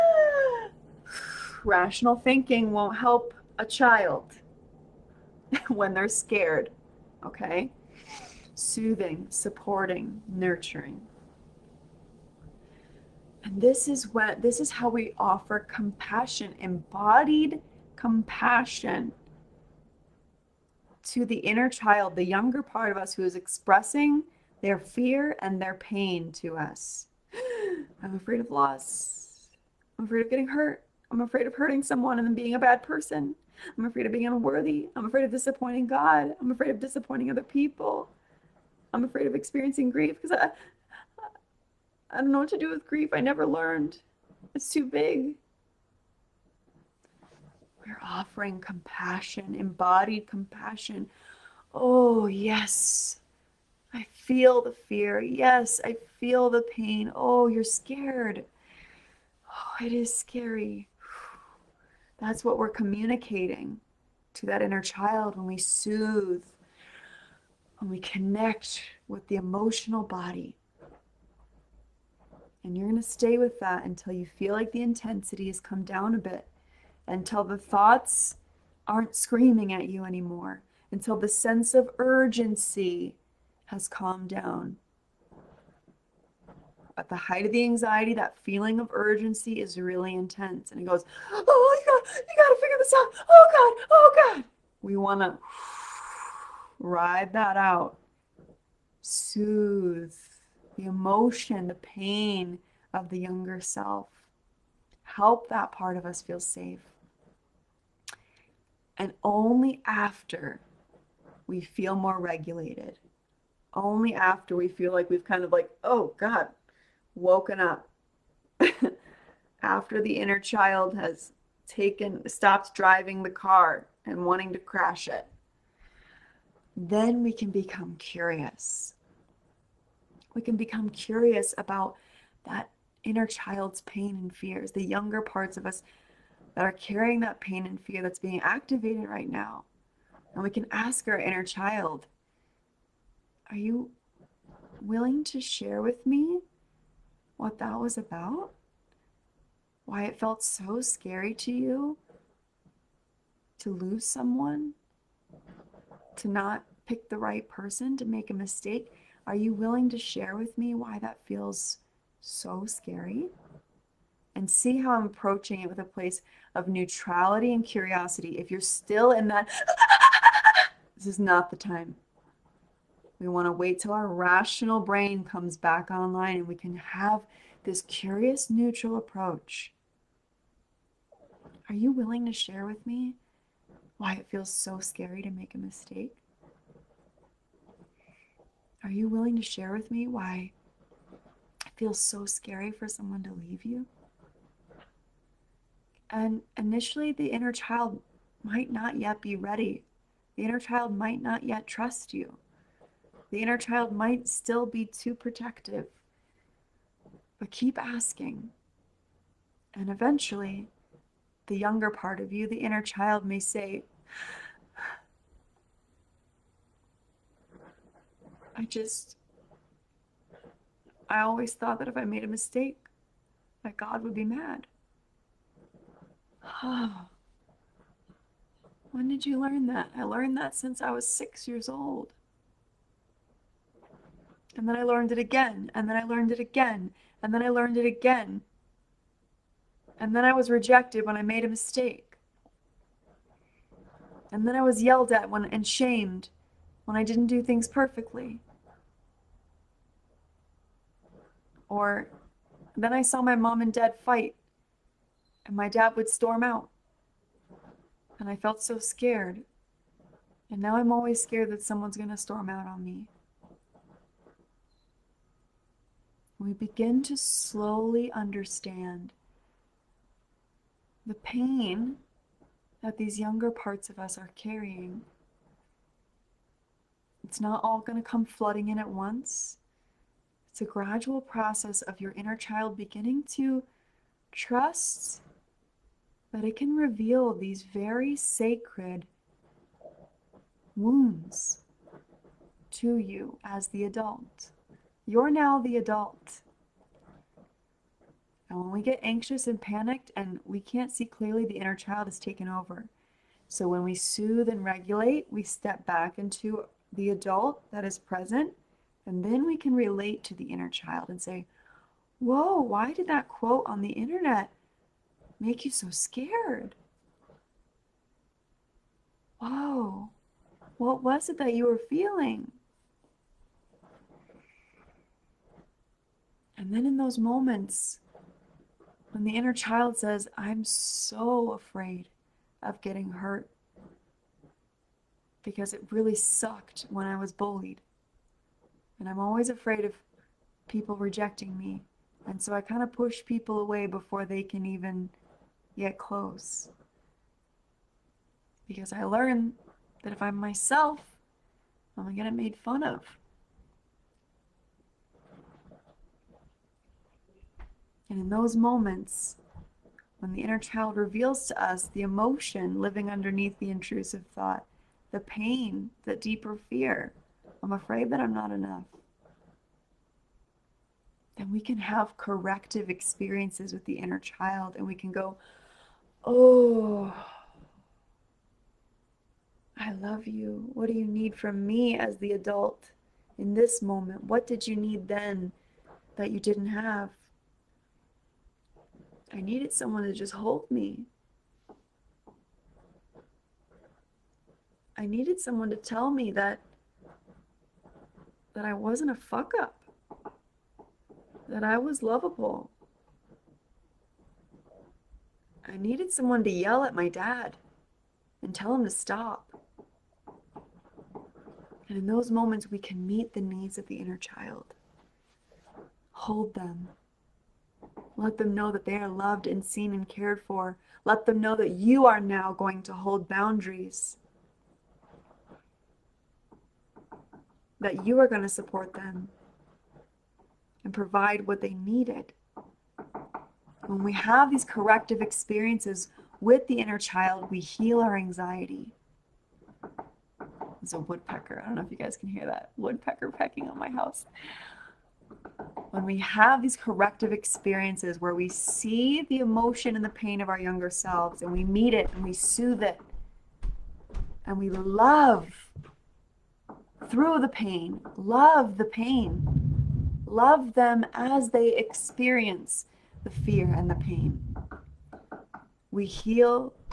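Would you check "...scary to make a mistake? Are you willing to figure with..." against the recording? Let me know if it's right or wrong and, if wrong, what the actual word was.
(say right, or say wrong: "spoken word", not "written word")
wrong: "share", not "figure".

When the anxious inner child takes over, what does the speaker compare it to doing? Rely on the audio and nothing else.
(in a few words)
driving the car.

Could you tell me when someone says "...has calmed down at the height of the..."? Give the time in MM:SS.
01:23.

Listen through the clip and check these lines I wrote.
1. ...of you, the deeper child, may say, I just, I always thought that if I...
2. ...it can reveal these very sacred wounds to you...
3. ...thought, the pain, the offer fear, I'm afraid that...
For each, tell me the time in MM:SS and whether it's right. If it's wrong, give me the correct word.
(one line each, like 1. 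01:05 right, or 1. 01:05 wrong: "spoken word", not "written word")
1. 03:32 wrong: "inner", not "deeper"
2. 04:46 right
3. 06:04 wrong: "deeper", not "offer".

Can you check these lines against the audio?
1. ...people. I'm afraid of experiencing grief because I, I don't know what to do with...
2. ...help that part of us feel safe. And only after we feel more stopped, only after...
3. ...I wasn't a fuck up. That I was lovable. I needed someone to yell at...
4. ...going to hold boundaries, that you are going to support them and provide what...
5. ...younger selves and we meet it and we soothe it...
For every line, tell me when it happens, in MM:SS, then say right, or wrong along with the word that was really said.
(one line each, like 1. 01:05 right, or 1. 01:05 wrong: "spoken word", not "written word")
1. 00:37 right
2. 01:45 wrong: "regulated", not "stopped"
3. 06:38 right
4. 07:02 right
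5. 07:30 right.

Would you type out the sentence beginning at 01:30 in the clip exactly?
And it goes, oh my God, you got to figure this out.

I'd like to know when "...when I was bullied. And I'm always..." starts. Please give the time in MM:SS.
05:36.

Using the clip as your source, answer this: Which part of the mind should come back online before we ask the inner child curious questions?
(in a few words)
rational brain.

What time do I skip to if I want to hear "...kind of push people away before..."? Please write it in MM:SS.
05:42.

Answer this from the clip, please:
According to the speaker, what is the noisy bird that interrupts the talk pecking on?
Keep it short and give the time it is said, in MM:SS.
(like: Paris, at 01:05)
my house, at 07:23.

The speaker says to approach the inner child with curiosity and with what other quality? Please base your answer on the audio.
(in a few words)
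neutrality.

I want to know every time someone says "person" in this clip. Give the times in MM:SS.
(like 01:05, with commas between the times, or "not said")
00:32, 02:37.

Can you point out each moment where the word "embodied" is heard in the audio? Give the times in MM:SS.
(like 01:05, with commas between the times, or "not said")
00:16, 00:49.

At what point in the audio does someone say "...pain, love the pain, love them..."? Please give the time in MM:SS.
07:37.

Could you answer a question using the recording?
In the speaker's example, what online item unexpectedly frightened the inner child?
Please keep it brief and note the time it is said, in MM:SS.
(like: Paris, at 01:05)
quote on the internet, at 05:13.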